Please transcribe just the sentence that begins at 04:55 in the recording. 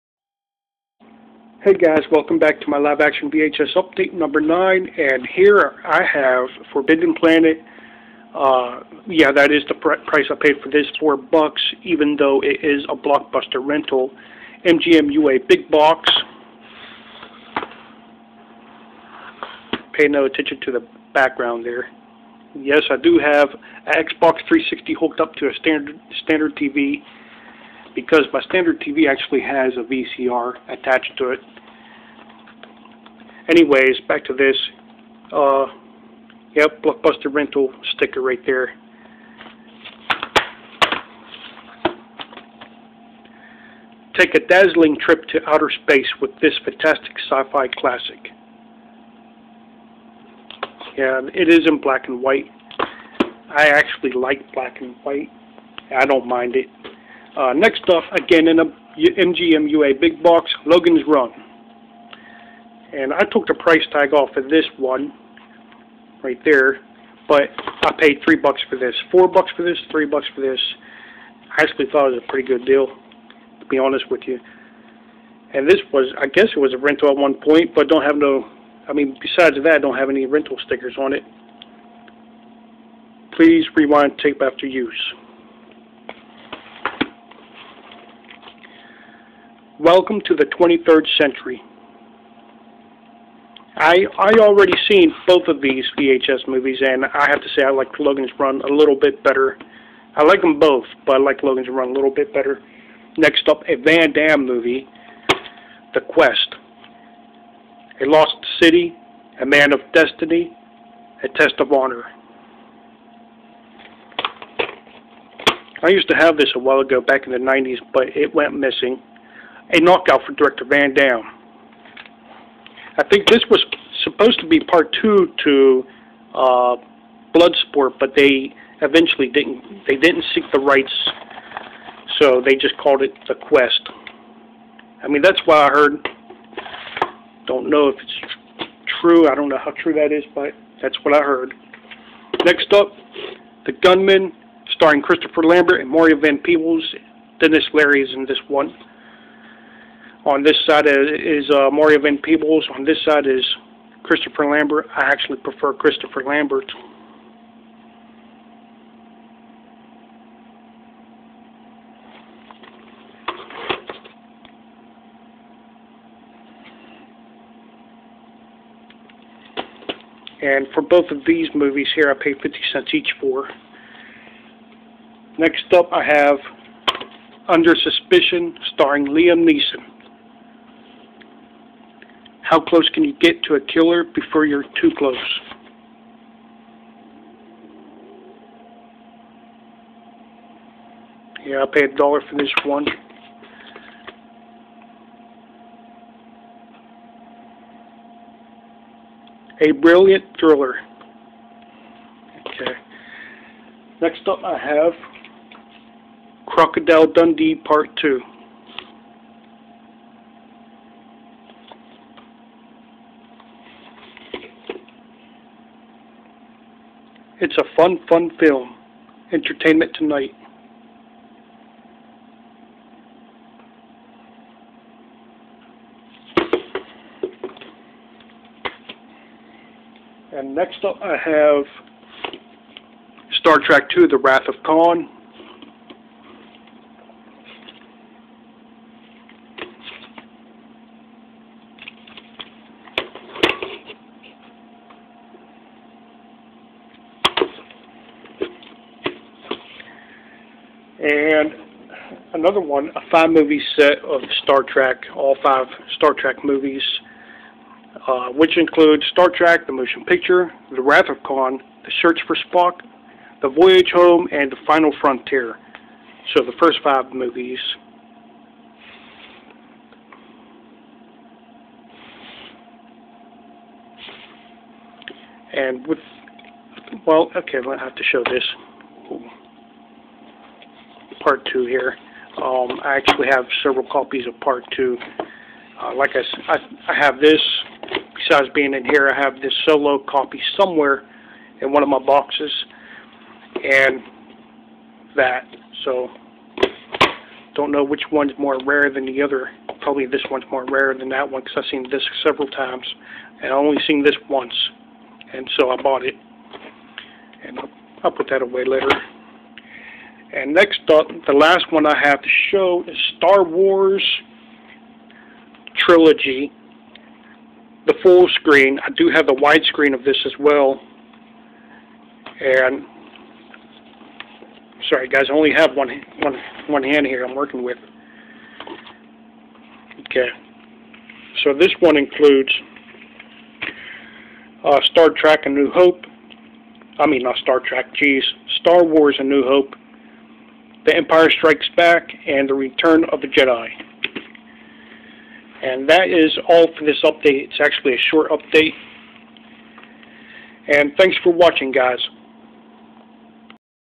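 So, don't know which one's more rare than the other.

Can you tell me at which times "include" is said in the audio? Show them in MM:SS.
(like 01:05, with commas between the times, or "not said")
04:18, 05:31.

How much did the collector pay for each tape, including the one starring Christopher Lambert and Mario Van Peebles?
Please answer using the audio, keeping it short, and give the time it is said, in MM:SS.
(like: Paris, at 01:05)
50 cents, at 02:52.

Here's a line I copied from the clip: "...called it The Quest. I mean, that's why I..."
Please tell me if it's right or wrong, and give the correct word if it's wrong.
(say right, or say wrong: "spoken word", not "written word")
right.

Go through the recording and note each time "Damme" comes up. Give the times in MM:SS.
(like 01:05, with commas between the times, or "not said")
01:44, 02:00.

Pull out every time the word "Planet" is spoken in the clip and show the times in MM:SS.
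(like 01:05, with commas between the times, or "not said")
00:07.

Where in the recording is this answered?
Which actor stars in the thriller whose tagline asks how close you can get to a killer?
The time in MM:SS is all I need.
02:59.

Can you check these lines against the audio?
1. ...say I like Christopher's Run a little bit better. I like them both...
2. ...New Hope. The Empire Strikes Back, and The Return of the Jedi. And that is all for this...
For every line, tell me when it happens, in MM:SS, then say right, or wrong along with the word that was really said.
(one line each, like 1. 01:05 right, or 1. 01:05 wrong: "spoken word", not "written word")
1. 01:37 wrong: "Logan", not "Christopher"
2. 05:39 right.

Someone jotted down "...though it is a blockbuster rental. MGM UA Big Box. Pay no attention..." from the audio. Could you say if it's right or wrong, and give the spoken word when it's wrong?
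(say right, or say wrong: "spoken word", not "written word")
right.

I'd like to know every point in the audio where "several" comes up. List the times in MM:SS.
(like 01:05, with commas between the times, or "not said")
04:43, 05:02.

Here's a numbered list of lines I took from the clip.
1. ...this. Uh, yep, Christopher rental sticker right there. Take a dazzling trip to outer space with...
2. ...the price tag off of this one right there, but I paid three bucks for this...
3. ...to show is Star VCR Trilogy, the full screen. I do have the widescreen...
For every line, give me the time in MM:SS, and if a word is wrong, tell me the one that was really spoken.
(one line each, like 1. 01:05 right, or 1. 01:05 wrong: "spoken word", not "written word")
1. 00:34 wrong: "Blockbuster", not "Christopher"
2. 01:03 right
3. 05:12 wrong: "Wars", not "VCR".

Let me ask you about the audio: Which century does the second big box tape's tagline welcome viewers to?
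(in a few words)
23rd century.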